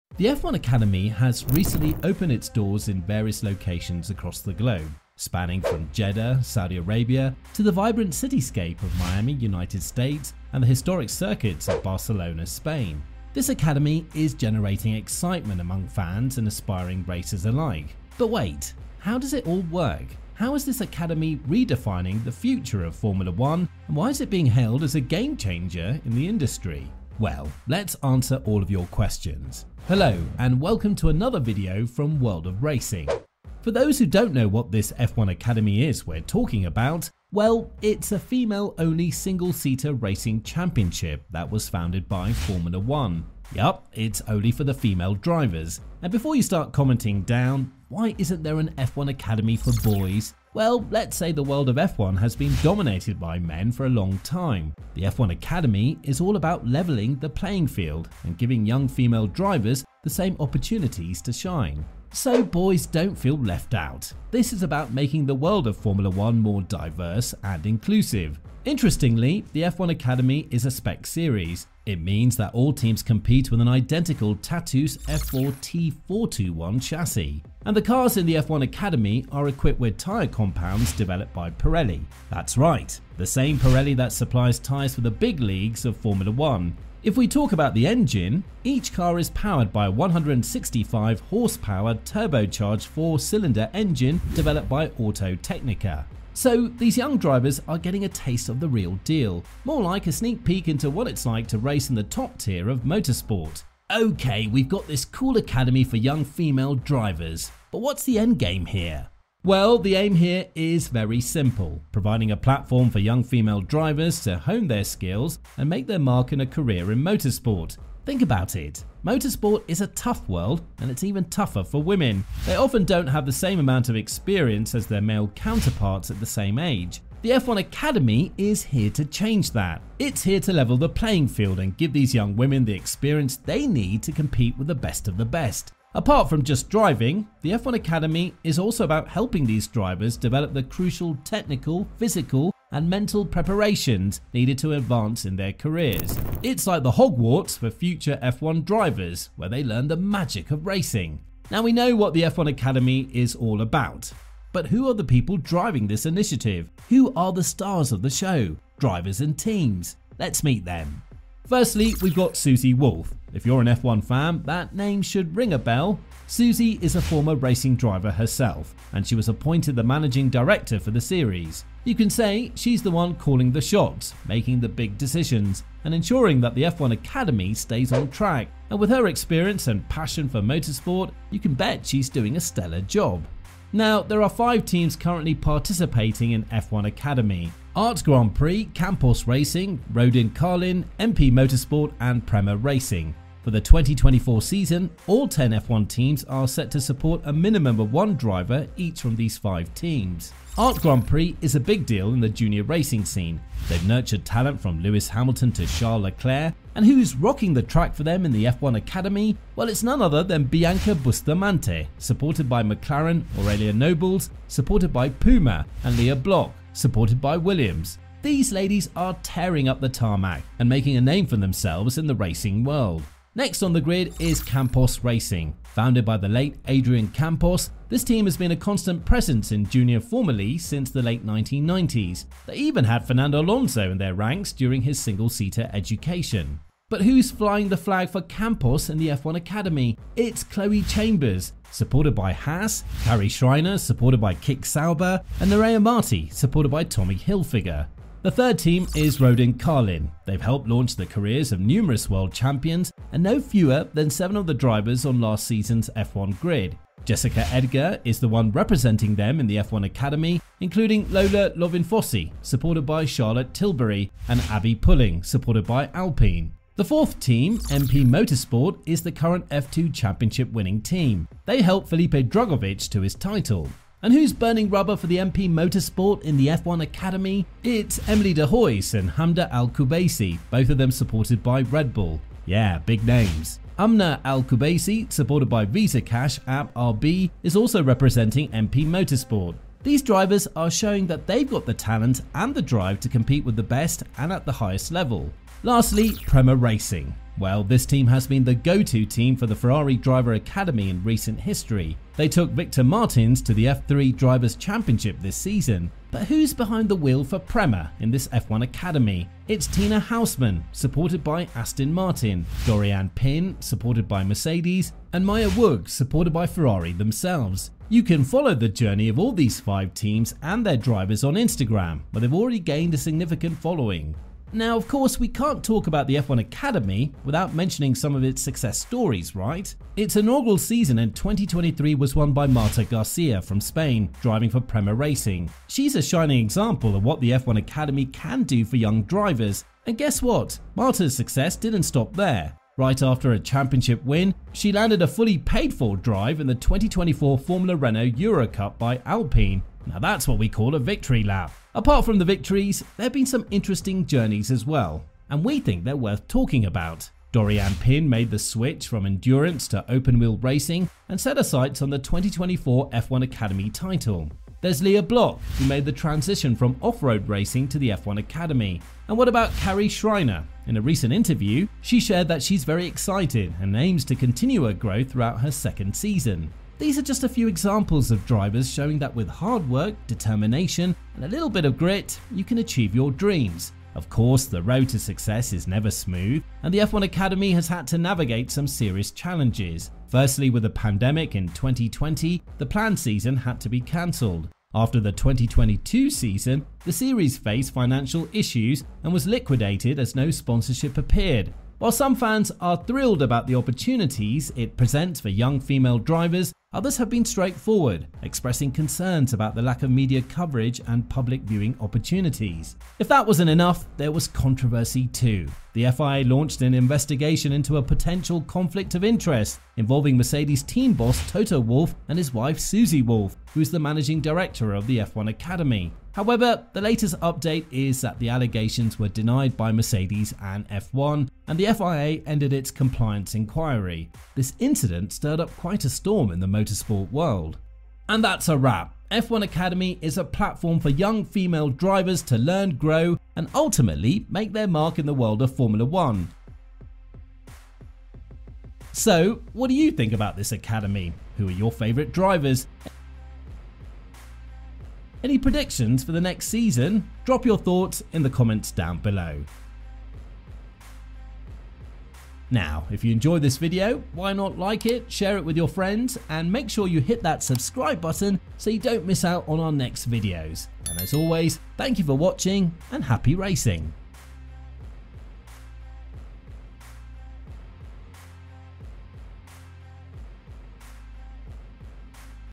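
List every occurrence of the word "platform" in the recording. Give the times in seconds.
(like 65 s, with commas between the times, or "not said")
112 s, 440 s.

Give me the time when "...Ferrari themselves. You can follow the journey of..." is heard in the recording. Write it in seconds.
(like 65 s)
316 s.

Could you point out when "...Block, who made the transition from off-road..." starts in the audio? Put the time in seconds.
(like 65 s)
365 s.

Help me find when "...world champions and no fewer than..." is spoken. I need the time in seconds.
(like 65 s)
252 s.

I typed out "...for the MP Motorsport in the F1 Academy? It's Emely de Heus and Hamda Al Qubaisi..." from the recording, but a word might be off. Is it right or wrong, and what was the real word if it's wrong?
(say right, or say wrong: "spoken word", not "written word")
right.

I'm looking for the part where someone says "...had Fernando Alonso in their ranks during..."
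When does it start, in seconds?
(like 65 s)
232 s.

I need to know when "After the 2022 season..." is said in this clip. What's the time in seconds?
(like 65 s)
394 s.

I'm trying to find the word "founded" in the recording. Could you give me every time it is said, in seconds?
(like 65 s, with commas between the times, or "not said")
41 s, 225 s.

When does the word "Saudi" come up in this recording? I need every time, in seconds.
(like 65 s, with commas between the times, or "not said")
6 s.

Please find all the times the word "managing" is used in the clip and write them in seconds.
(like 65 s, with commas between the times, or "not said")
169 s, 423 s.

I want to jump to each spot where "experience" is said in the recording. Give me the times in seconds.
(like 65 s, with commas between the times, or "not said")
123 s, 132 s, 179 s.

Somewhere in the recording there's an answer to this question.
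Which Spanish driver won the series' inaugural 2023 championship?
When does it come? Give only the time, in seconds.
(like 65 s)
332 s.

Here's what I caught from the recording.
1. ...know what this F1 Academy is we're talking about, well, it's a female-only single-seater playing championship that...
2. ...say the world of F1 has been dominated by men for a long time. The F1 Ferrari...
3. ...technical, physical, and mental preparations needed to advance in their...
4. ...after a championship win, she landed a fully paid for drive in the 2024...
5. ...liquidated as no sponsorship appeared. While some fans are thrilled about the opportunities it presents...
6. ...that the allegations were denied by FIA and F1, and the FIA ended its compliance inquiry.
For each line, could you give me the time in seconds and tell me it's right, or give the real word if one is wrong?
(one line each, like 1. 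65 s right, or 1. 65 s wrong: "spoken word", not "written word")
1. 34 s wrong: "racing", not "playing"
2. 51 s wrong: "Academy", not "Ferrari"
3. 141 s right
4. 343 s right
5. 399 s right
6. 428 s wrong: "Mercedes", not "FIA".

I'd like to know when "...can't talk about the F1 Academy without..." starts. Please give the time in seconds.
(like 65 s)
325 s.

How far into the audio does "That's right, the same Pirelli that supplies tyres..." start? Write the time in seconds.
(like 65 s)
82 s.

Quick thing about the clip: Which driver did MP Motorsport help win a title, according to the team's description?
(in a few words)
Felipe Drugovich.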